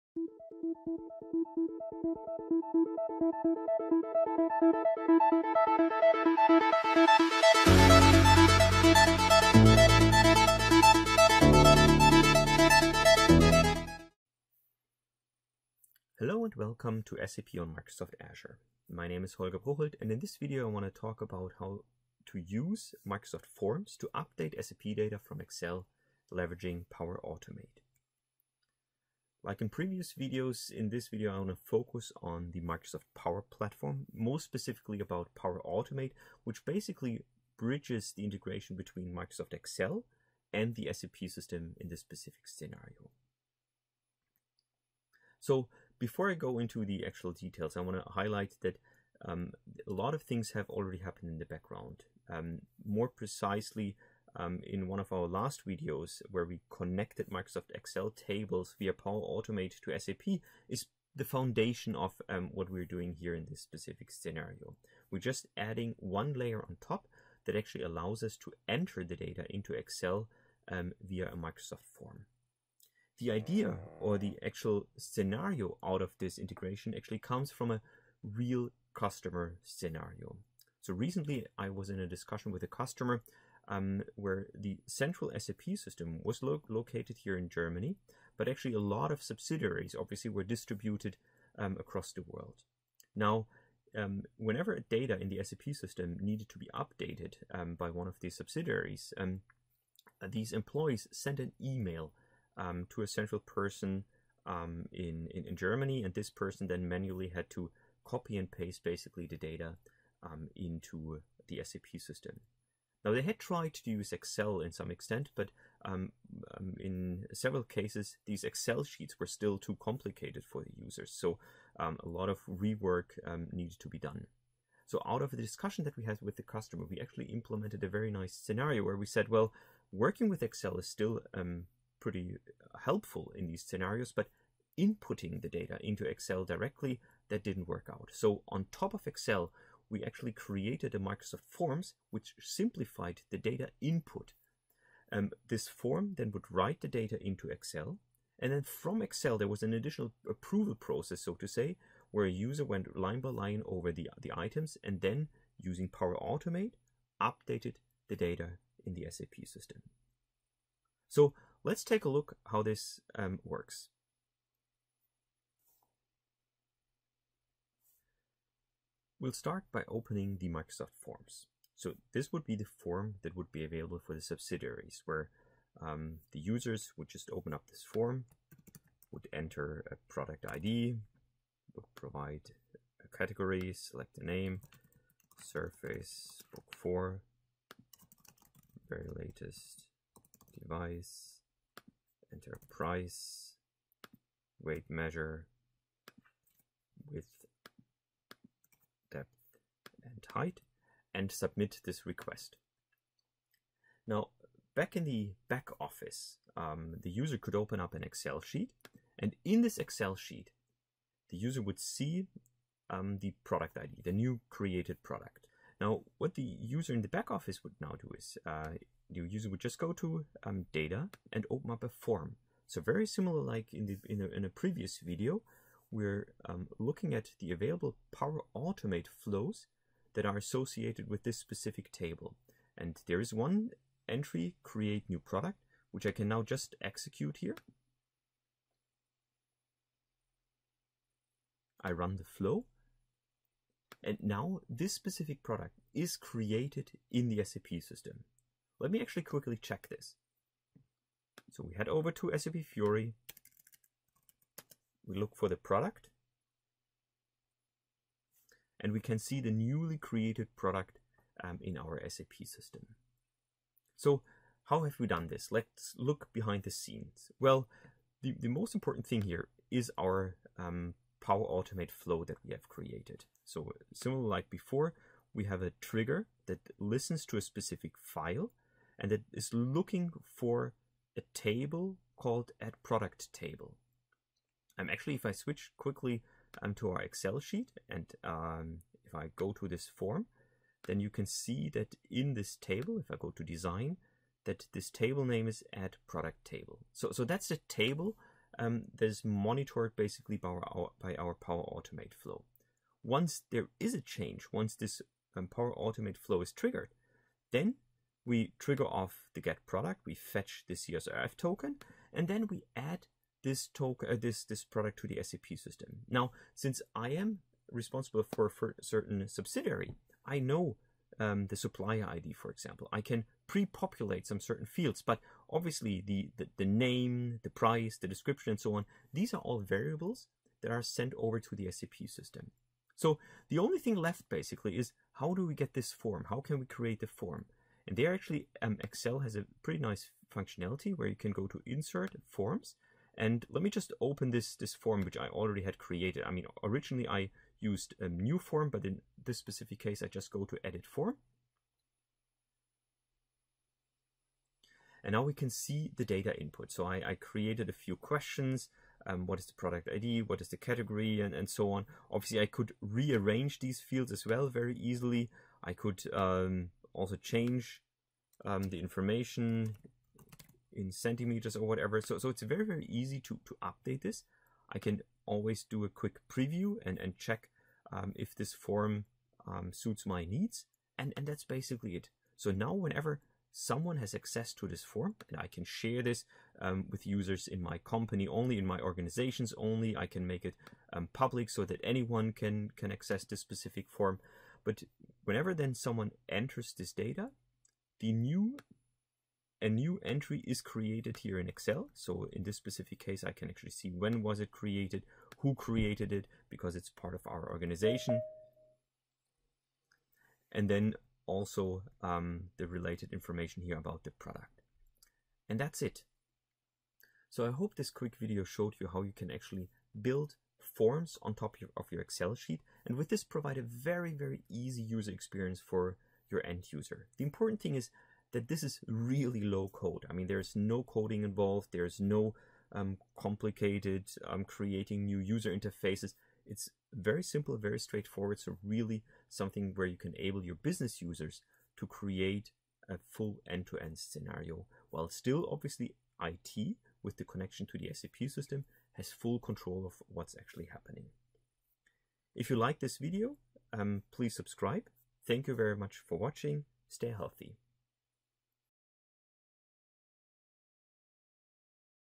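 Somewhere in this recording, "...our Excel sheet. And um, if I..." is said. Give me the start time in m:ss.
4:46.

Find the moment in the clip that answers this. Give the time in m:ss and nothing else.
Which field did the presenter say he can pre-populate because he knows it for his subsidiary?
5:21.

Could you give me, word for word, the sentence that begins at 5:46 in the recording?
I mean, originally I used a new form, but in this specific case, I just go to edit form.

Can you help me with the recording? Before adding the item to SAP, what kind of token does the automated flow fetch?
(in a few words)
CSRF token.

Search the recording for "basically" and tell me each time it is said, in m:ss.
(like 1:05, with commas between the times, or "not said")
0:36, 1:48, 4:59, 5:34, 6:21.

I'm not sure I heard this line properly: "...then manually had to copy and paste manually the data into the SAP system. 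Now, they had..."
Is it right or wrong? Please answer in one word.
wrong.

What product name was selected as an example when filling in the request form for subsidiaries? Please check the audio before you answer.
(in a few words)
Surface Book 4.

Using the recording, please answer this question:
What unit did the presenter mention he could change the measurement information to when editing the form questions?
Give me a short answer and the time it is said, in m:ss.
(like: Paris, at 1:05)
centimeters, at 6:10.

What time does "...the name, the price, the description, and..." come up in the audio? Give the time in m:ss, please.
5:26.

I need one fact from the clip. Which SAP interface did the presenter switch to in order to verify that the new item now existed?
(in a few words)
SAP Fiori.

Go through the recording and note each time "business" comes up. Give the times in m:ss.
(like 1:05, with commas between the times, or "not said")
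7:20.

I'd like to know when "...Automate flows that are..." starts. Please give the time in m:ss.
3:48.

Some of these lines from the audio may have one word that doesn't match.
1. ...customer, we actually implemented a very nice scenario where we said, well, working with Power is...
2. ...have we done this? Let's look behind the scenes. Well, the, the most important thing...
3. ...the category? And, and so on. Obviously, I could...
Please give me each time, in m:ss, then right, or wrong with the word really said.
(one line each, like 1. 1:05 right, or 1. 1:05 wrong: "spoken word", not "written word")
1. 2:06 wrong: "Excel", not "Power"
2. 4:24 right
3. 6:00 right.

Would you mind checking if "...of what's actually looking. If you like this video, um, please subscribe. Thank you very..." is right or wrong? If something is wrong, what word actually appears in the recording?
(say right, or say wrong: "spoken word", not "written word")
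wrong: "happening", not "looking".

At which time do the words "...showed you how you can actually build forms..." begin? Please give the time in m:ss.
6:58.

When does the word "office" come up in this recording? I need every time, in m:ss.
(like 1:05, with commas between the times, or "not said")
3:25, 3:37.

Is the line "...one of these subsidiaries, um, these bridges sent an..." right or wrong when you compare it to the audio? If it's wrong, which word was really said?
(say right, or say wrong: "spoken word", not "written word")
wrong: "employees", not "bridges".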